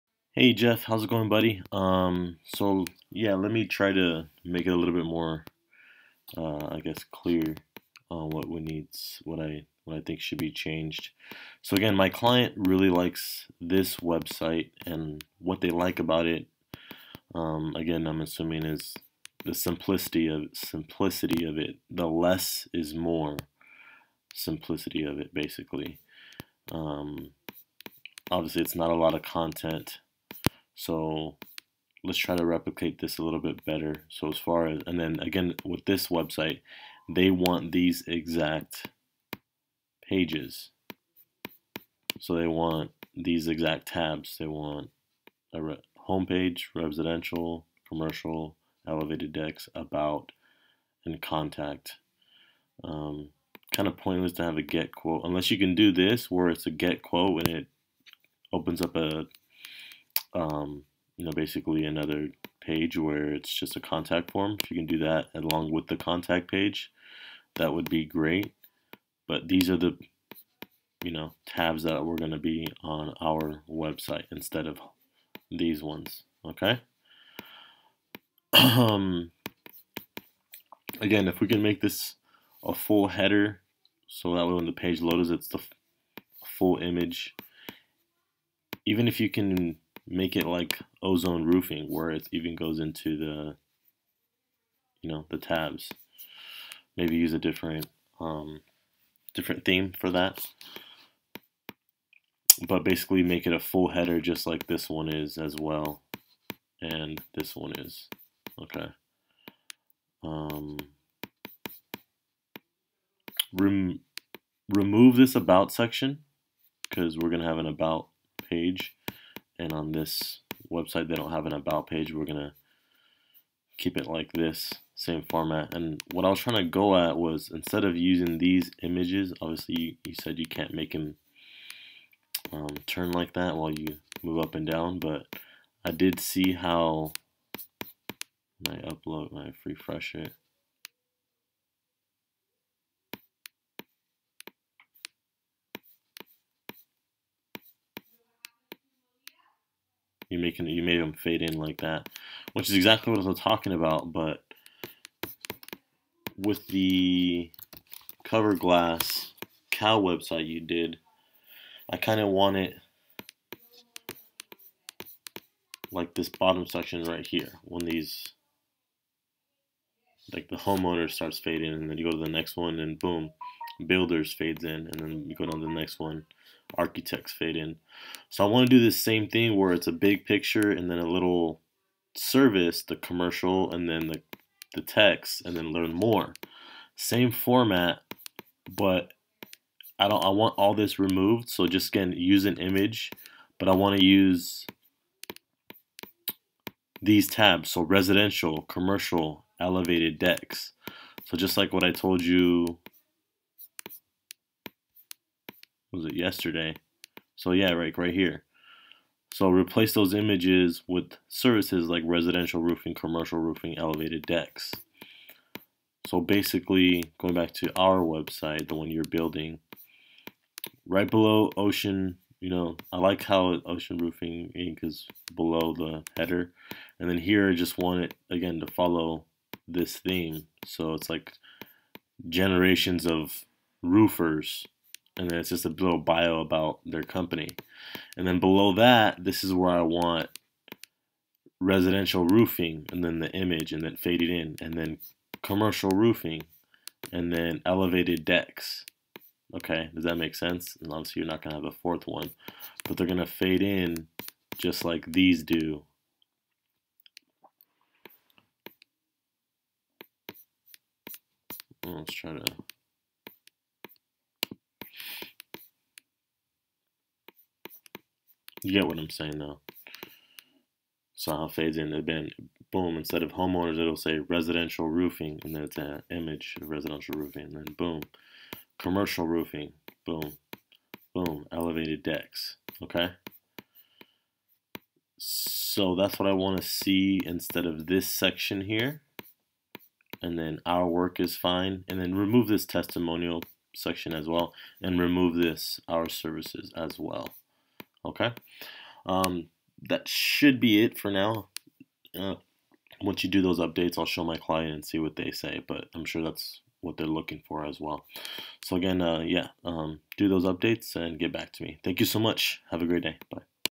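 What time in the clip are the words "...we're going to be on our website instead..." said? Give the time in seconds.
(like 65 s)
72 s.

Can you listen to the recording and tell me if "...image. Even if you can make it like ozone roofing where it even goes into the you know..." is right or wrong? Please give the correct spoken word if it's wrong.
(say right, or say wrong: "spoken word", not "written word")
right.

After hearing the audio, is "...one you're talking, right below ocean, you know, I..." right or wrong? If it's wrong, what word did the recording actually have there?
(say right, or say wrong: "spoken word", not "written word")
wrong: "building", not "talking".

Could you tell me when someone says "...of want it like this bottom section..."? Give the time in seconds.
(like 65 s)
162 s.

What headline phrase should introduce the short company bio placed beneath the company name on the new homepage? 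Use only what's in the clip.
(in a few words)
generations of roofers.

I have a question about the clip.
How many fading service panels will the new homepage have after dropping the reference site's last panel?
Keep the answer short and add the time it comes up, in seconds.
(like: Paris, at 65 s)
3, at 251 s.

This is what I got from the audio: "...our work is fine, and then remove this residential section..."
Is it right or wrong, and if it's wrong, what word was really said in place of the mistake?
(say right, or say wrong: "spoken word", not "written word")
wrong: "testimonial", not "residential".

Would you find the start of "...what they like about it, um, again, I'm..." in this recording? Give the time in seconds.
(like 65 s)
15 s.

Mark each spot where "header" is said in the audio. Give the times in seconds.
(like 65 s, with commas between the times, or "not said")
83 s, 103 s, 226 s.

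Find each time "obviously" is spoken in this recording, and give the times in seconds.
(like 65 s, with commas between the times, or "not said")
28 s, 129 s, 250 s.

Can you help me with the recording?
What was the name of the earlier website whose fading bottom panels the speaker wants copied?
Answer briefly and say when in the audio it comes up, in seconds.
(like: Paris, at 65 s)
cover glass cow, at 158 s.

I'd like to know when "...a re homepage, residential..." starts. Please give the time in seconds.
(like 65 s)
45 s.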